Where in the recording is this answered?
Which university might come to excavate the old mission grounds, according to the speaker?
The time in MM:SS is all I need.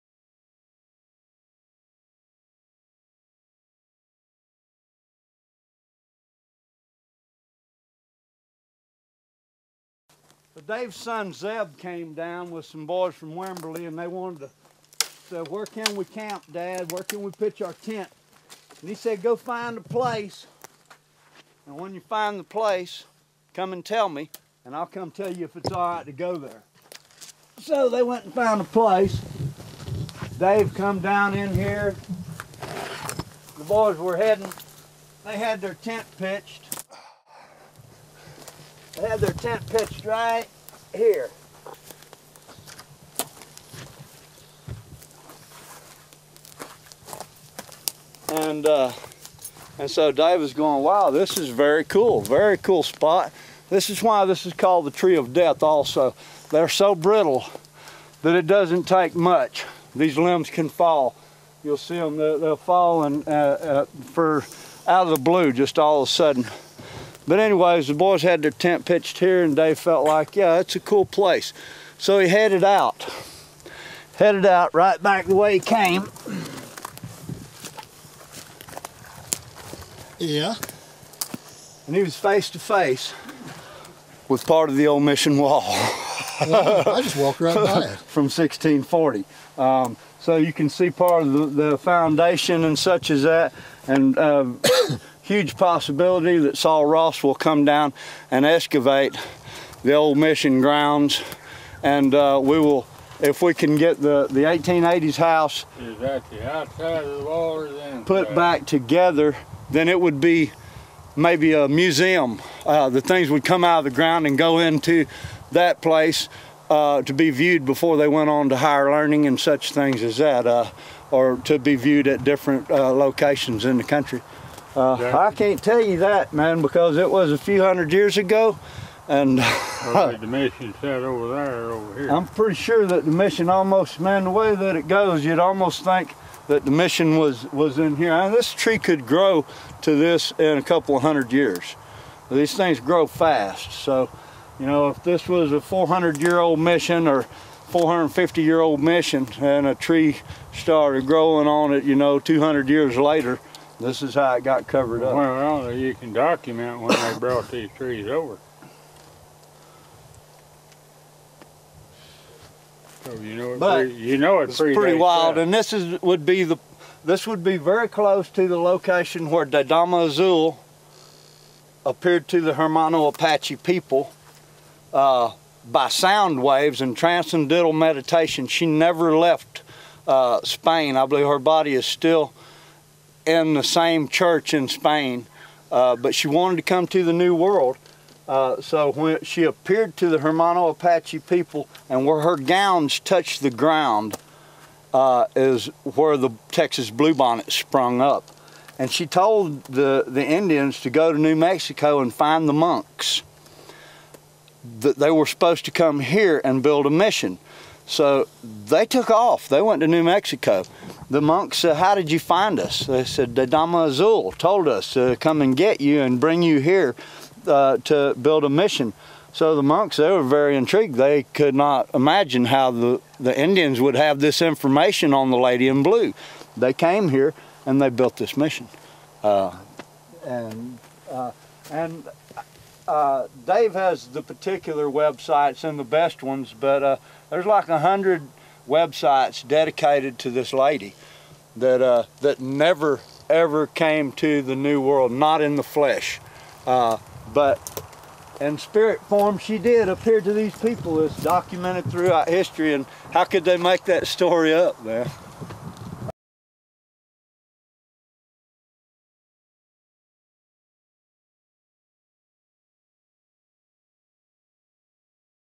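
01:36.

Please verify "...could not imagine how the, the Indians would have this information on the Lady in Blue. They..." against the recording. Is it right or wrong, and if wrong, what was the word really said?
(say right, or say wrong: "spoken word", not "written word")
right.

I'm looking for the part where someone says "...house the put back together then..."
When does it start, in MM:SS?
01:45.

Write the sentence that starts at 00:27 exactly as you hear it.
So they went and found a place.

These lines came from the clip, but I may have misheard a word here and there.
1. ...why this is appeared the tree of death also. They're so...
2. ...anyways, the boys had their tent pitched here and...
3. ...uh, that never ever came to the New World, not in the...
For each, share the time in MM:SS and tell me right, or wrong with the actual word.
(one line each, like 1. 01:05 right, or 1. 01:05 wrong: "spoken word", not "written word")
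1. 00:54 wrong: "called", not "appeared"
2. 01:07 right
3. 04:01 right.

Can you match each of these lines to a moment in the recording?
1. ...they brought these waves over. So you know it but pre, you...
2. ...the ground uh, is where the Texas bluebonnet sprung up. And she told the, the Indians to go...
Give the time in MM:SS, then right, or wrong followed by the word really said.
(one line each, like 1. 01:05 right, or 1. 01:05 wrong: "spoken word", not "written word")
1. 02:36 wrong: "trees", not "waves"
2. 03:13 right.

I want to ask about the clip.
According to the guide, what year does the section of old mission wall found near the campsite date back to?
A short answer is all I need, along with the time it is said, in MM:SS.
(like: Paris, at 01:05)
1640, at 01:28.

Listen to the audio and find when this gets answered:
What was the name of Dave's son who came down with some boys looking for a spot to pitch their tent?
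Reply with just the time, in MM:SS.
00:11.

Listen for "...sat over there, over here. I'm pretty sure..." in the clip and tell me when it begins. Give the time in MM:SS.
02:10.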